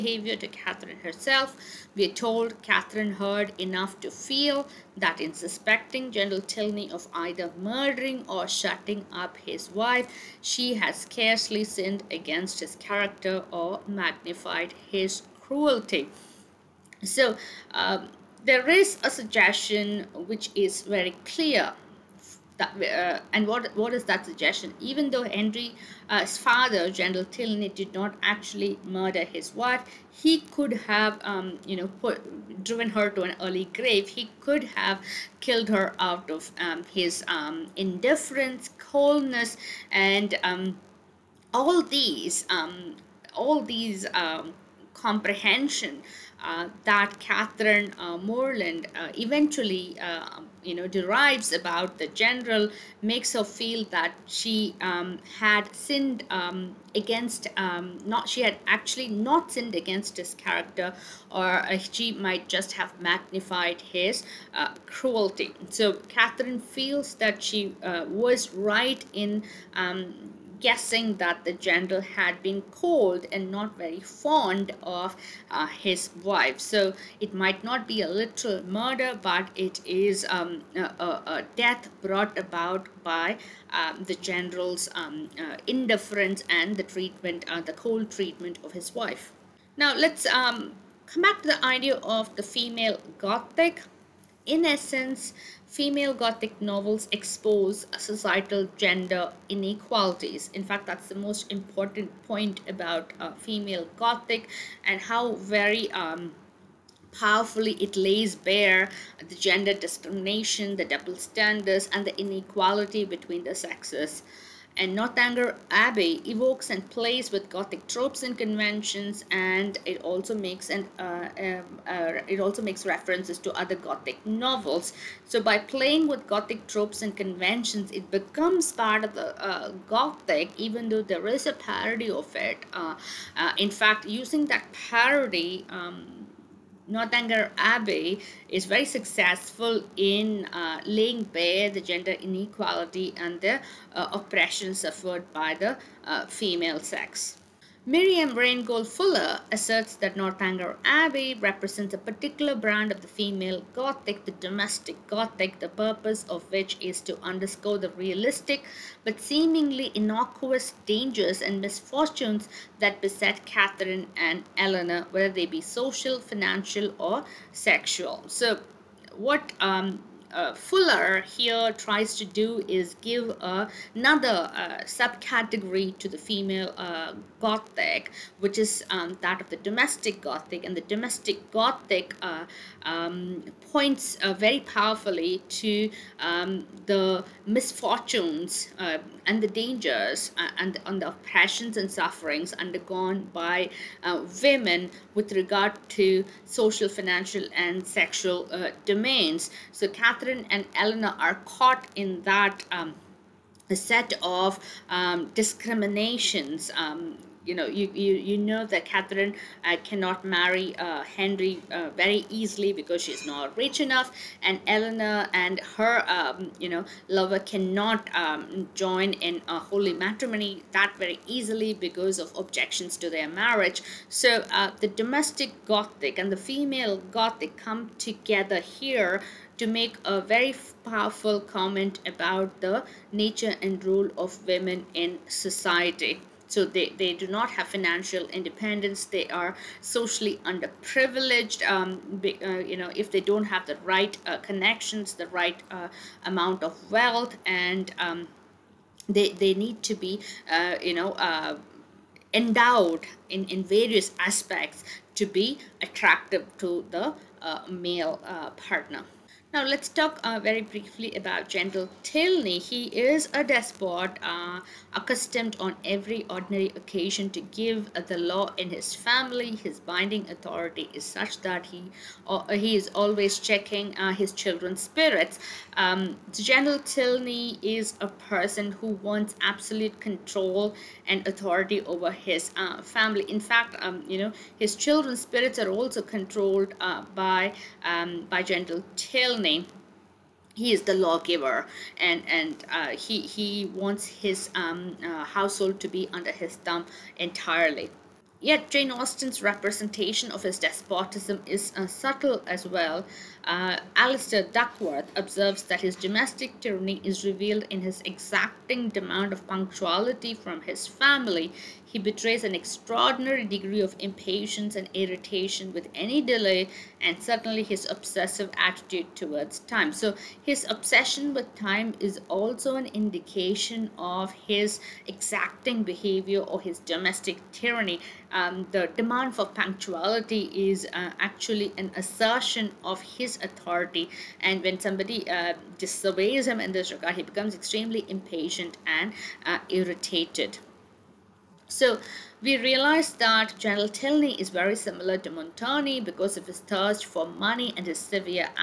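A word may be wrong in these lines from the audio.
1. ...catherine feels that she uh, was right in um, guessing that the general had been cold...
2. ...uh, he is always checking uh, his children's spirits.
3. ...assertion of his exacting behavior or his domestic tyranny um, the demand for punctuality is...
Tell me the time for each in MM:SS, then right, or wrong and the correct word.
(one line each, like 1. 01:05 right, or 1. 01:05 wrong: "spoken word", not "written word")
1. 01:06 right
2. 04:32 right
3. 05:22 wrong: "indication", not "assertion".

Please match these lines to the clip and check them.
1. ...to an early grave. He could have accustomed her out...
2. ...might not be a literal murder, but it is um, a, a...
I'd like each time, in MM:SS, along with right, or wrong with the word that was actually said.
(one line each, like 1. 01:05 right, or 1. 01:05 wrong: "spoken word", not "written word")
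1. 00:33 wrong: "killed", not "accustomed"
2. 01:17 right.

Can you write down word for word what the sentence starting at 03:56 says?
So they, they do not have financial independence.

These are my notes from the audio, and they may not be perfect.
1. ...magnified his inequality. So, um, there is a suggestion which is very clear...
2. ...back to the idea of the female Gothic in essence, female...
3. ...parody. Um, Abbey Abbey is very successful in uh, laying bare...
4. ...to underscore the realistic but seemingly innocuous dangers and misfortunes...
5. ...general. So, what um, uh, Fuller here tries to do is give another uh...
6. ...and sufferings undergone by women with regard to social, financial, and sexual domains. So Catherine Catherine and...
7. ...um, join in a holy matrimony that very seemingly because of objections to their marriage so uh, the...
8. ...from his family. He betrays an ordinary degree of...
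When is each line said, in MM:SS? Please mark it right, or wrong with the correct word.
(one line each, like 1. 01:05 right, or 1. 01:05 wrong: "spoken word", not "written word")
1. 00:13 wrong: "cruelty", not "inequality"
2. 01:31 right
3. 02:14 wrong: "Northanger", not "Abbey"
4. 02:37 right
5. 02:47 wrong: "sexual", not "general"
6. 03:11 right
7. 03:38 wrong: "easily", not "seemingly"
8. 05:10 wrong: "extraordinary", not "ordinary".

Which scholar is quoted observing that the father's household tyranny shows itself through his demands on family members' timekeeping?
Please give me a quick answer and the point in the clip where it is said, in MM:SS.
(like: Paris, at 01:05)
Alistair Duckworth, at 05:03.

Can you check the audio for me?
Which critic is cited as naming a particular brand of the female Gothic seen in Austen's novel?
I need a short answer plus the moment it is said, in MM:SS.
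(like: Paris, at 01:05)
Miriam Rheingold Fuller, at 02:27.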